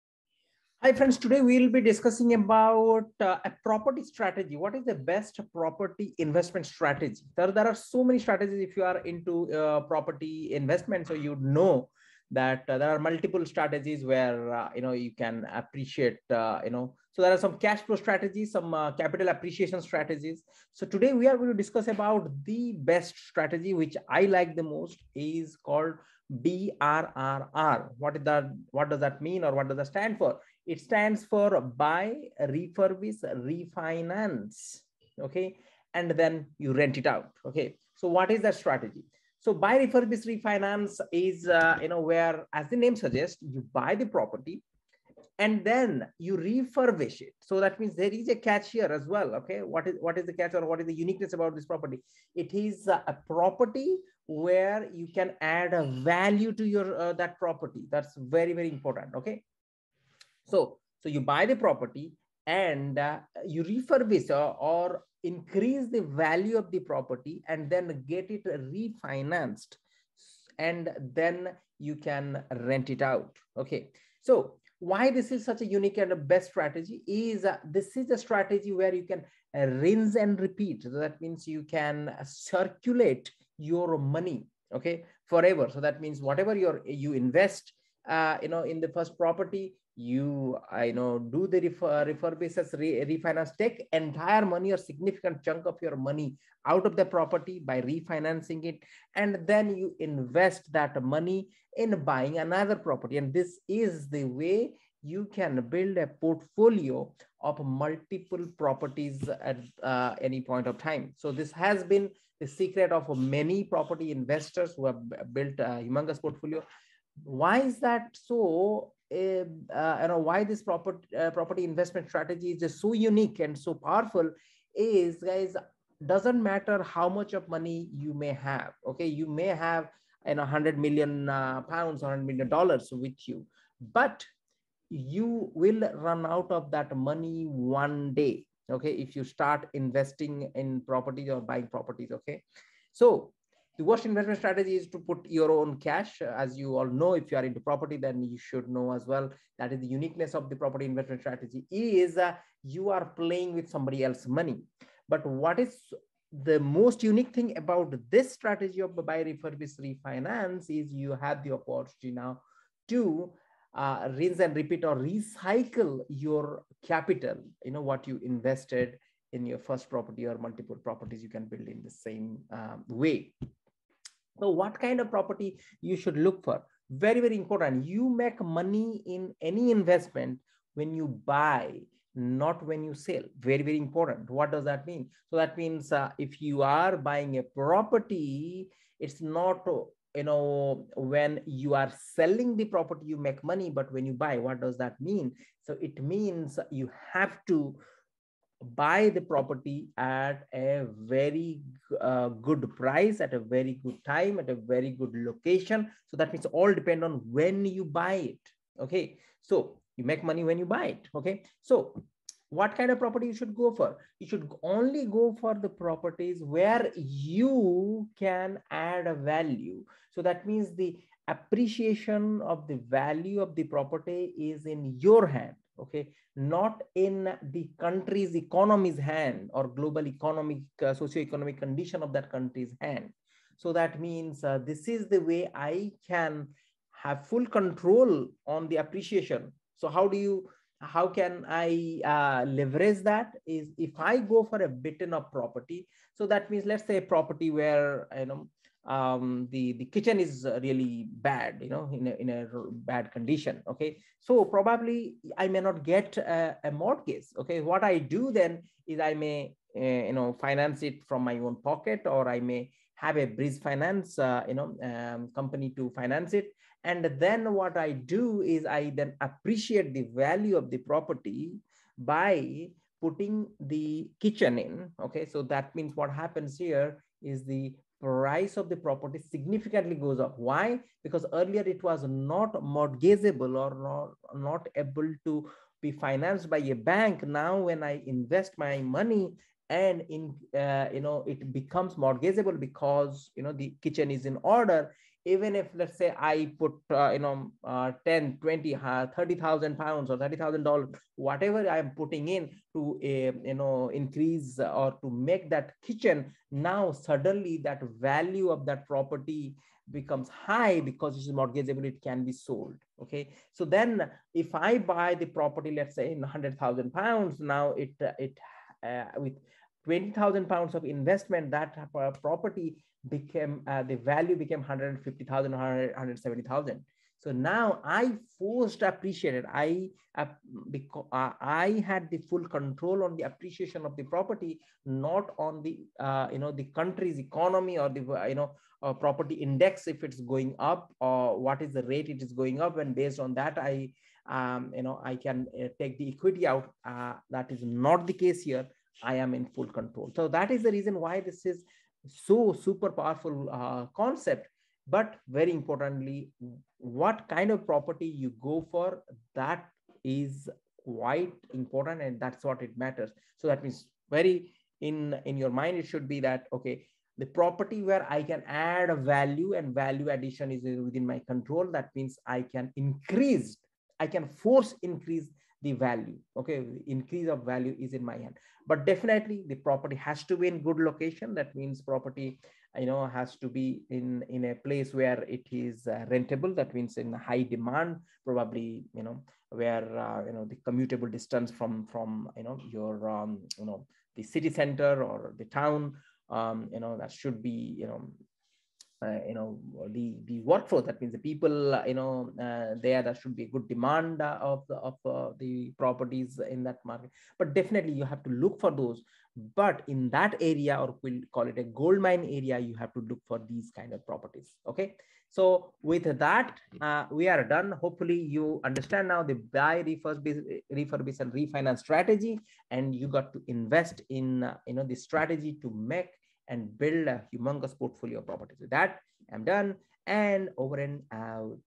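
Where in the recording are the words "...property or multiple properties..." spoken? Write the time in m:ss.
2:49.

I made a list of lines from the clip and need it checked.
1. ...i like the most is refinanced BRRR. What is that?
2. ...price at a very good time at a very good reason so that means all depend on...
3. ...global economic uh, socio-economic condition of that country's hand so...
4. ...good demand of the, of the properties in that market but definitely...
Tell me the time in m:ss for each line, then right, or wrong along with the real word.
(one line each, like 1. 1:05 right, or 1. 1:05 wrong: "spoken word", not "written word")
1. 0:24 wrong: "called", not "refinanced"
2. 3:22 wrong: "location", not "reason"
3. 3:49 right
4. 6:43 right.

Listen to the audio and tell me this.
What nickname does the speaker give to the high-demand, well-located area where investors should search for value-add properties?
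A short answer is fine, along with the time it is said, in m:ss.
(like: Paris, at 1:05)
Gold mine area, at 6:51.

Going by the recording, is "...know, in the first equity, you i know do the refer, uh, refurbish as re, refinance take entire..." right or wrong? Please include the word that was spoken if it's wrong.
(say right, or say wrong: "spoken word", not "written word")
wrong: "property", not "equity".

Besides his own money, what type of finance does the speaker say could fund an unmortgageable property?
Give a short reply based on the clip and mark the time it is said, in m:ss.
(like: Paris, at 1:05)
Bridge finance, at 4:23.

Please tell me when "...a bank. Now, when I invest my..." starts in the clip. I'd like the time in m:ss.
4:46.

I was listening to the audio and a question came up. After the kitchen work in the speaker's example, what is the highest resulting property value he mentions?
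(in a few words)
170,000.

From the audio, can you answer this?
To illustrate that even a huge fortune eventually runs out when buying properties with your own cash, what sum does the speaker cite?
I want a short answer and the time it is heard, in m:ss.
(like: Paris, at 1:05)
100 million pounds, at 2:10.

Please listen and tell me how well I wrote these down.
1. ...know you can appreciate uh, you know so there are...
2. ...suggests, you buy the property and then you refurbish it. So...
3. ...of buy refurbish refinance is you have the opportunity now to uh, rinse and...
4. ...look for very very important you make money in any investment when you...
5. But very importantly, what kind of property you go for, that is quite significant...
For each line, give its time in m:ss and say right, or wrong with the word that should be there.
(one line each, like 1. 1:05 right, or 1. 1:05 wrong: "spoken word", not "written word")
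1. 0:14 right
2. 0:42 right
3. 2:38 right
4. 2:56 right
5. 5:54 wrong: "important", not "significant".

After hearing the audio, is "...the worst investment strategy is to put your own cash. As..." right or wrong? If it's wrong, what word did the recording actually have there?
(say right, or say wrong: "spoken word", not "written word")
right.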